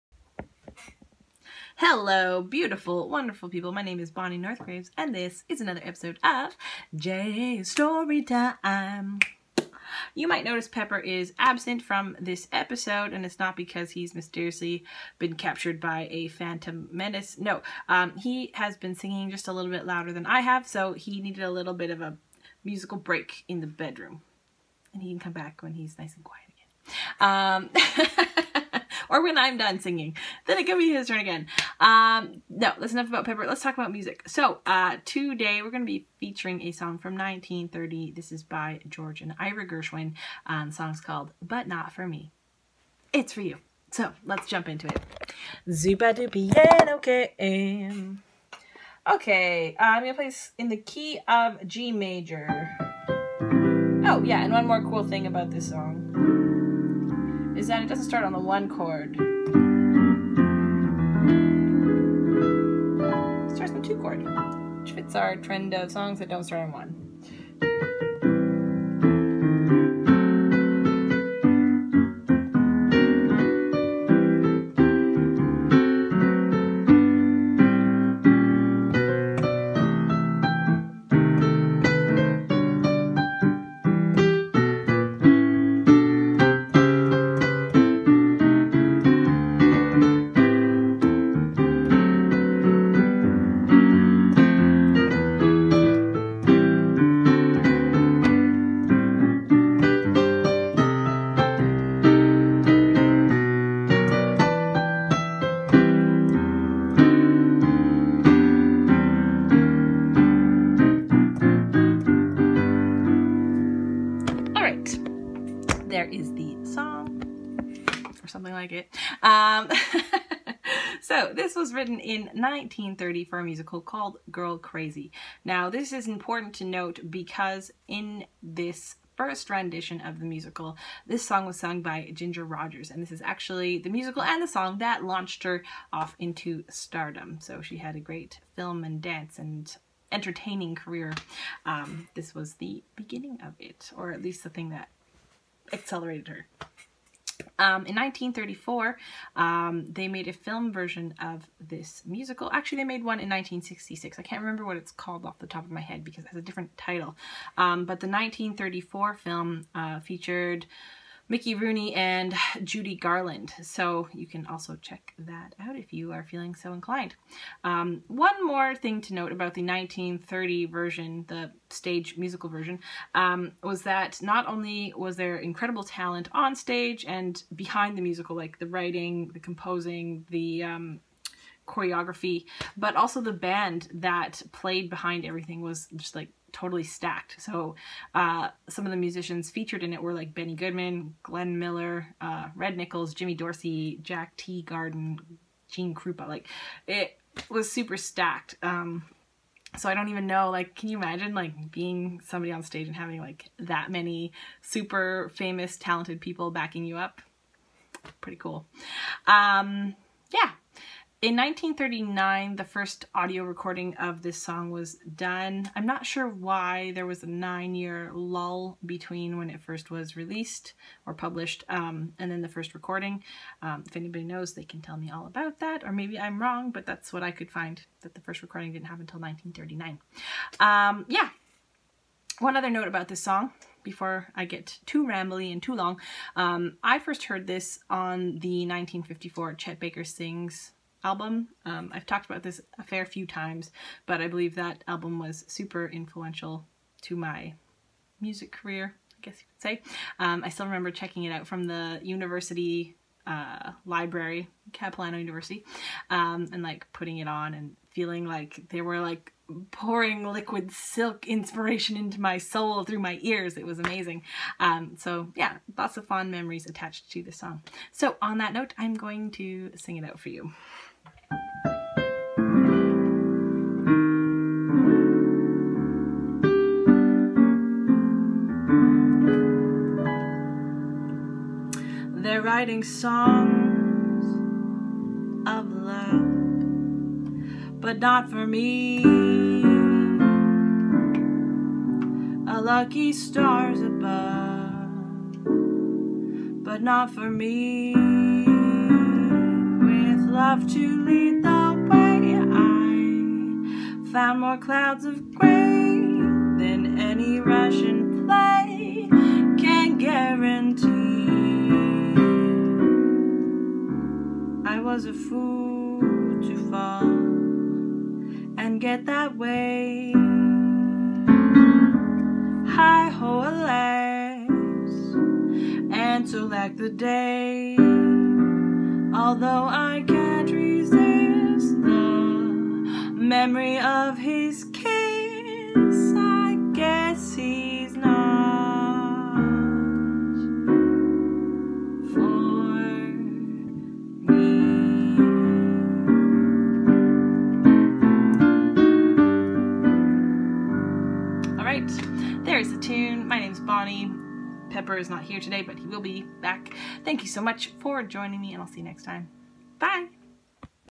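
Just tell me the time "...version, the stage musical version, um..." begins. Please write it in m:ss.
2:50.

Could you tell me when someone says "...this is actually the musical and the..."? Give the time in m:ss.
2:13.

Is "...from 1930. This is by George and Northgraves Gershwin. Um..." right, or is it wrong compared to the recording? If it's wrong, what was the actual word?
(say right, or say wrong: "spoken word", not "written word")
wrong: "Ira", not "Northgraves".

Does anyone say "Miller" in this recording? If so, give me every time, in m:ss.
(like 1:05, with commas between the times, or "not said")
3:11.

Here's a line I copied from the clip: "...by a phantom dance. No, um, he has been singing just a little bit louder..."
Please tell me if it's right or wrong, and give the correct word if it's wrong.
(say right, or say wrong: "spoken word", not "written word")
wrong: "menace", not "dance".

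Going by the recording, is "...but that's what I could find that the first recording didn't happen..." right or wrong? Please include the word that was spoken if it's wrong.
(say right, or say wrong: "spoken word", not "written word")
right.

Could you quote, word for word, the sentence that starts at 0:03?
My name is Bonnie Northgraves, and this is another episode of Jazz Story Time.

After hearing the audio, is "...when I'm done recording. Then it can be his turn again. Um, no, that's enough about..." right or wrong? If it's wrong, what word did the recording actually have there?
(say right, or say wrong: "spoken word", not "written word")
wrong: "singing", not "recording".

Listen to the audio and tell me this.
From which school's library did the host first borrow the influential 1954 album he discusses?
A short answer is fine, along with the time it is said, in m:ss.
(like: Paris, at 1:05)
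Capilano University, at 4:14.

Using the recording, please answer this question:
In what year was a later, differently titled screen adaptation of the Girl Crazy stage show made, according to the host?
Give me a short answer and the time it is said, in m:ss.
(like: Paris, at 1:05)
1966, at 2:33.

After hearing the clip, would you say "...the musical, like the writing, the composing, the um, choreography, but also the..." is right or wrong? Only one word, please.
right.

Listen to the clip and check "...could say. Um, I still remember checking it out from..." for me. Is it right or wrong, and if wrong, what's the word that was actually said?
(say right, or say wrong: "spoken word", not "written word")
right.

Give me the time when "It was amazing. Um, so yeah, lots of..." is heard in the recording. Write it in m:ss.
4:23.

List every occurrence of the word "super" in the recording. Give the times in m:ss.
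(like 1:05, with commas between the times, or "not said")
3:17, 3:24, 4:05.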